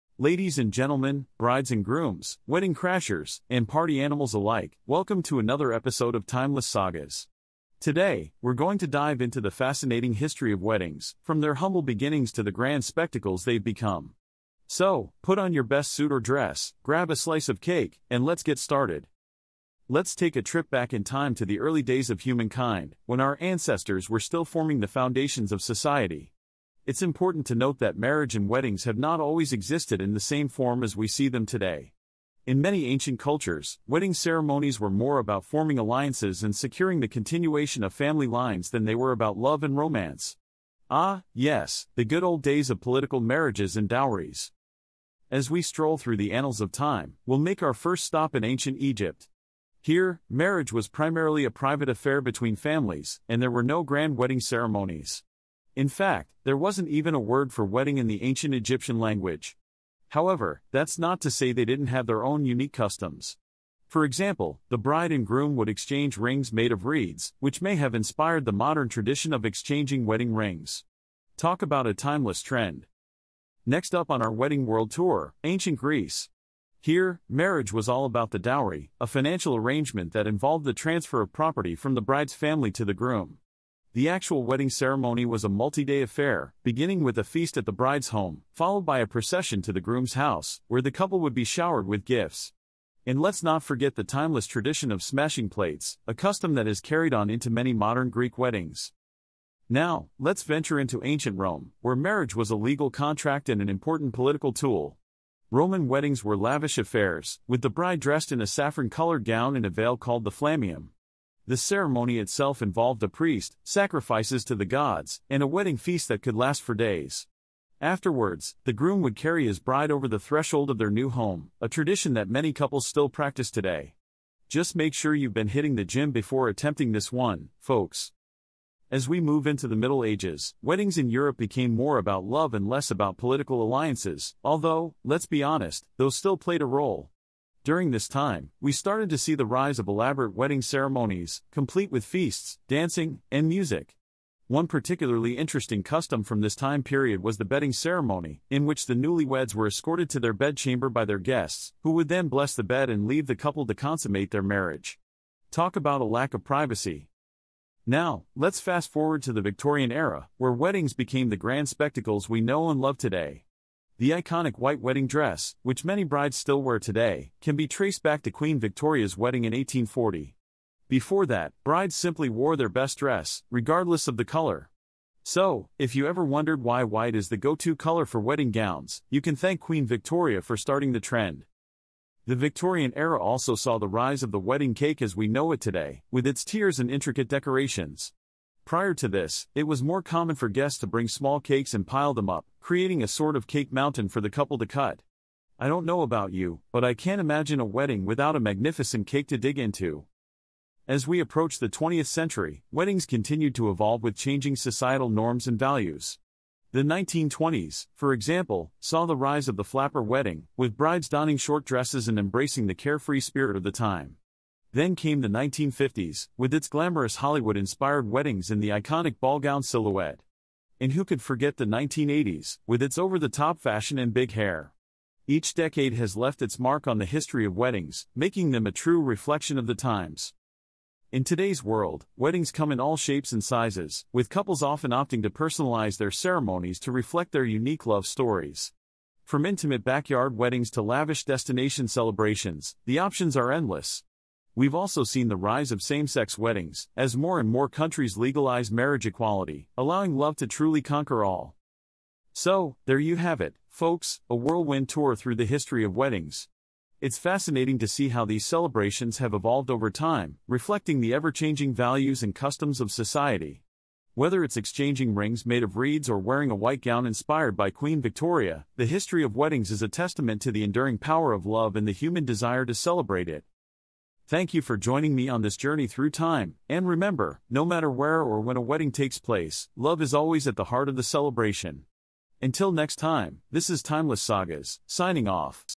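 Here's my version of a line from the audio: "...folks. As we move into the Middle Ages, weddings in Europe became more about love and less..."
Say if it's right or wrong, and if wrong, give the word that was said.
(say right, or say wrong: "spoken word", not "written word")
right.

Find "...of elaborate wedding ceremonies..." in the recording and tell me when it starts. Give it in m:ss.
2:19.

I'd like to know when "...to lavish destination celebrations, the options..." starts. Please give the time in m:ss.
4:00.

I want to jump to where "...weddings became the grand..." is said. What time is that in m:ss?
2:40.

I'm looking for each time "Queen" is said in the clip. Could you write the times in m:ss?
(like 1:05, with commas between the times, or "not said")
2:48, 2:59, 4:27.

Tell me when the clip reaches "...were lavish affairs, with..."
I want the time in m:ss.
1:46.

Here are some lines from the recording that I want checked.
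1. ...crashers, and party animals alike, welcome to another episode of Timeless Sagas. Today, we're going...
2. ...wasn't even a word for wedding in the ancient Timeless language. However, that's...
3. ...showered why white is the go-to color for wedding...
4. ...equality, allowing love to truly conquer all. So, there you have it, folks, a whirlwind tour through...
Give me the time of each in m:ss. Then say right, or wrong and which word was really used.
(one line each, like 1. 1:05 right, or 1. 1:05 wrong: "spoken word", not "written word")
1. 0:02 right
2. 0:56 wrong: "Egyptian", not "Timeless"
3. 2:56 wrong: "wondered", not "showered"
4. 4:09 right.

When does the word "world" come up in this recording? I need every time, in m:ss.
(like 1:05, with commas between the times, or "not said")
1:14, 3:51.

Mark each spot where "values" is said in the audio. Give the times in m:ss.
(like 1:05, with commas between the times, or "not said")
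3:25, 4:21.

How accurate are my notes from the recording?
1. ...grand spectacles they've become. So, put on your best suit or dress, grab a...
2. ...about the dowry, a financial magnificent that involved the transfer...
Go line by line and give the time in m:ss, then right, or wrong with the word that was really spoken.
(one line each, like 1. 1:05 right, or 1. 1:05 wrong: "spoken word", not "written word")
1. 0:12 right
2. 1:18 wrong: "arrangement", not "magnificent".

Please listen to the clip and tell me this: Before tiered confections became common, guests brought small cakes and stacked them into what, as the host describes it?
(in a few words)
Cake mountain.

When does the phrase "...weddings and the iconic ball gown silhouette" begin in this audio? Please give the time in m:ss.
3:38.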